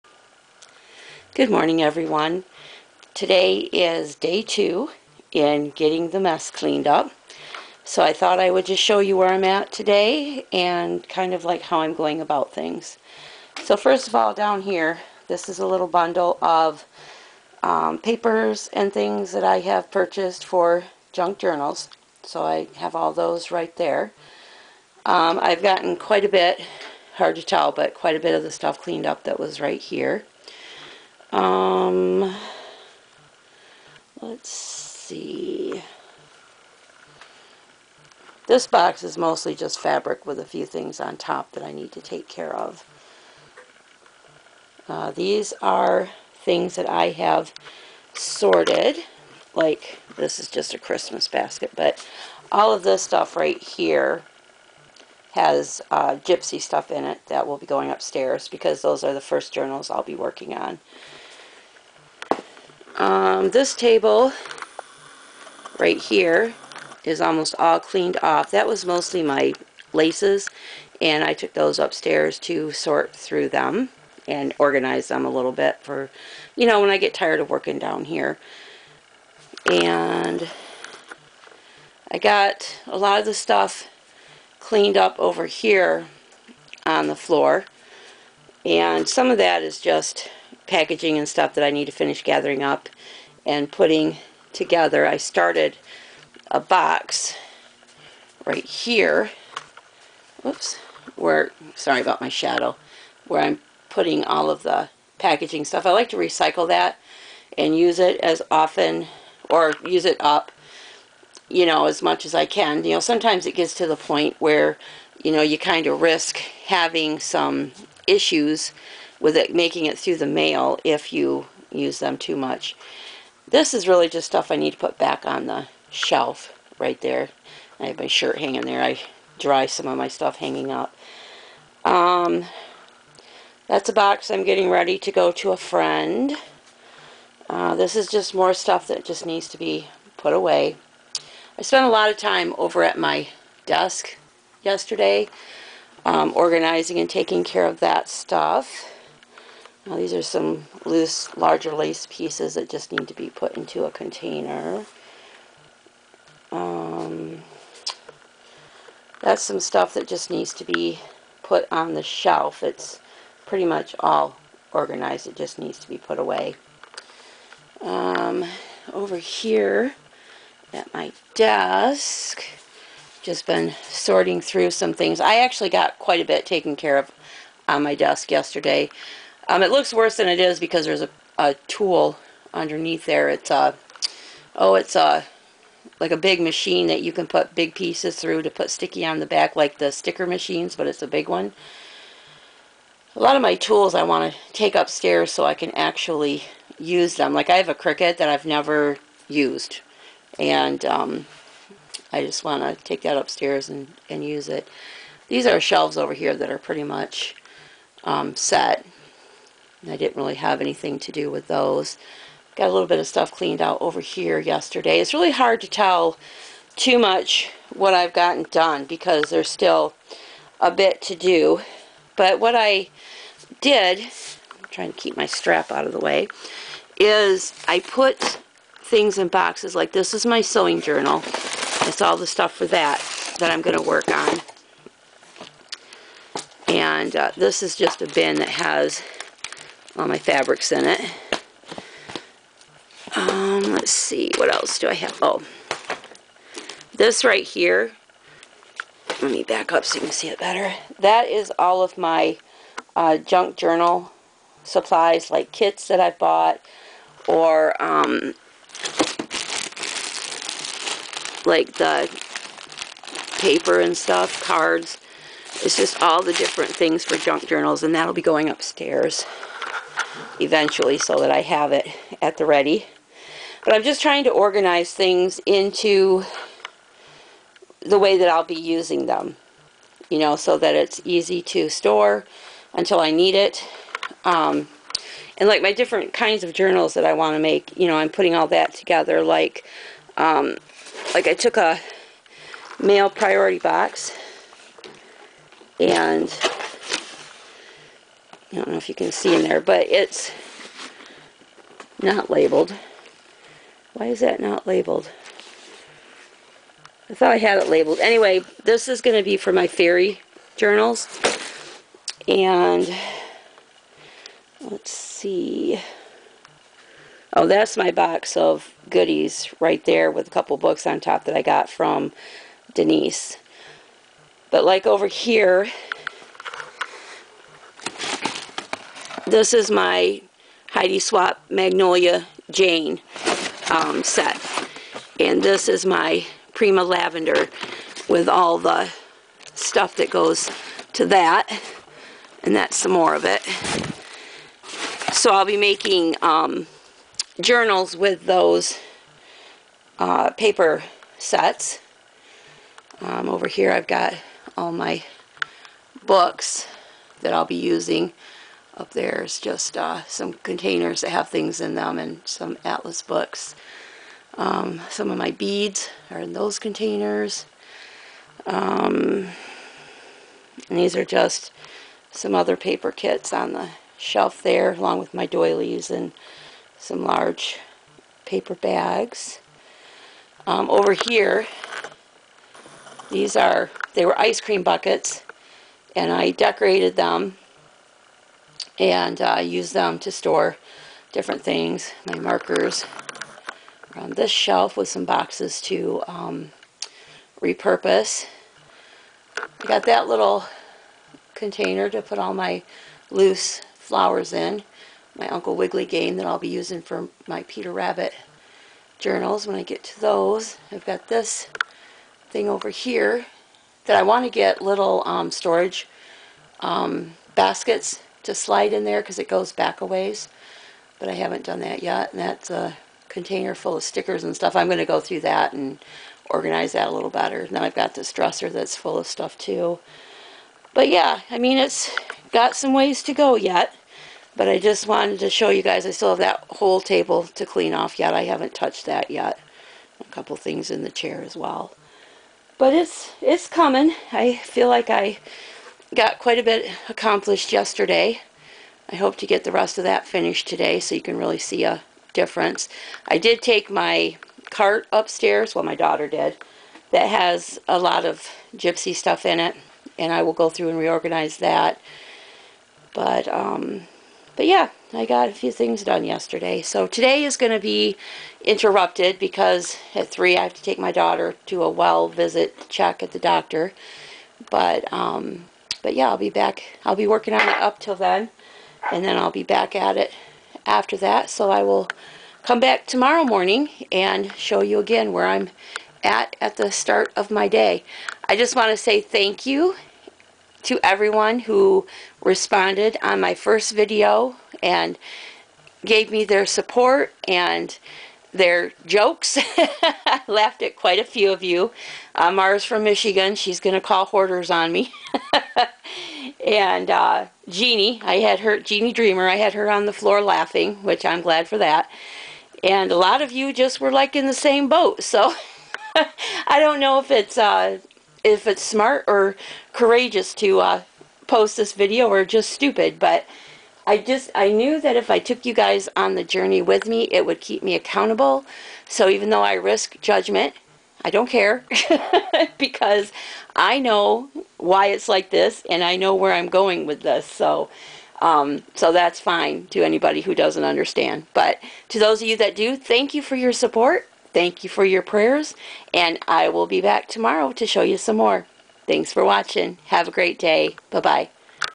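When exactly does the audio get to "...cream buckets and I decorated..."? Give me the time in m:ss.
6:24.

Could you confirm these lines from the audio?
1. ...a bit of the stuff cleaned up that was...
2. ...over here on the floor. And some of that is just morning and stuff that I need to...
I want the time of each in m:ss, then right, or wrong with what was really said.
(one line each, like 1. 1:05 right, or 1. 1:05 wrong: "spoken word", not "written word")
1. 0:28 right
2. 1:25 wrong: "packaging", not "morning".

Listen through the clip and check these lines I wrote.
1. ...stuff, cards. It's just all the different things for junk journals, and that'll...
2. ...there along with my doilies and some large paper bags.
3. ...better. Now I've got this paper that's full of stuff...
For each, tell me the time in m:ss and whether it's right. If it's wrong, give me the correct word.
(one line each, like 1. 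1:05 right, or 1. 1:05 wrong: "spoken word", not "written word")
1. 4:23 right
2. 6:14 right
3. 7:07 wrong: "dresser", not "paper".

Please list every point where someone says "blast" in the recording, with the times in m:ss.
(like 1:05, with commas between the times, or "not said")
not said.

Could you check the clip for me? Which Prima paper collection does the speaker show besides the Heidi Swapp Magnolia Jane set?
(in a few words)
Prima Lavender.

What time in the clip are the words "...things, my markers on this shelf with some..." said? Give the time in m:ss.
6:31.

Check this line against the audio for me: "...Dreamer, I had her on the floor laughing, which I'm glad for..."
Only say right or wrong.
right.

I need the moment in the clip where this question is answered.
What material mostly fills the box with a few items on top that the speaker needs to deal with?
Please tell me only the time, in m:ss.
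0:39.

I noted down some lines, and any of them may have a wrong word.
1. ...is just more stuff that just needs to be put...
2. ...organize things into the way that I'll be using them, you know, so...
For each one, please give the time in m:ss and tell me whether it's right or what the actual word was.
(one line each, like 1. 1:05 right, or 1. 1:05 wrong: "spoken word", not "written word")
1. 2:17 right
2. 4:34 right.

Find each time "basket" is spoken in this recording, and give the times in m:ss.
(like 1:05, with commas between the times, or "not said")
0:51, 6:57.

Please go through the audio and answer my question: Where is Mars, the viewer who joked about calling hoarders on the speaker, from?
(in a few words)
Michigan.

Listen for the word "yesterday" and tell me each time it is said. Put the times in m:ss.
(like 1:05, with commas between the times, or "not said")
2:24, 2:58, 3:34, 7:27, 7:46.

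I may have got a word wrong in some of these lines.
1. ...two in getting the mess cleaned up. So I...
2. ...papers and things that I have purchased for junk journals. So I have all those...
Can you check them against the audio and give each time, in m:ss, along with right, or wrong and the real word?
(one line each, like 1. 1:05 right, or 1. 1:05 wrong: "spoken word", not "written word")
1. 0:04 right
2. 0:17 right.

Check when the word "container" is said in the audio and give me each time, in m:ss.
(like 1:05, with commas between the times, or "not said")
2:33, 6:00, 6:06, 6:41, 7:03.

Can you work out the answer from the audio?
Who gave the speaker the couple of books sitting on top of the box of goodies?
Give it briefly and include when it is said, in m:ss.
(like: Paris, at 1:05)
Denise, at 5:22.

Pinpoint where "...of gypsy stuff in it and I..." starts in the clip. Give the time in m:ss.
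7:38.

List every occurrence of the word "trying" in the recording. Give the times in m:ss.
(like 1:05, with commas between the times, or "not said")
3:44, 4:34.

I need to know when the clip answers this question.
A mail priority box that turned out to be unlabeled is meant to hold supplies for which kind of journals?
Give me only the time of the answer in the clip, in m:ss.
5:09.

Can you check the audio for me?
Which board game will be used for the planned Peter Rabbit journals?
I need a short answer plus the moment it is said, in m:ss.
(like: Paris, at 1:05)
Uncle Wiggily, at 6:45.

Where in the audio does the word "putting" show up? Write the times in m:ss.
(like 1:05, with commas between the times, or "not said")
1:33, 1:43, 4:48.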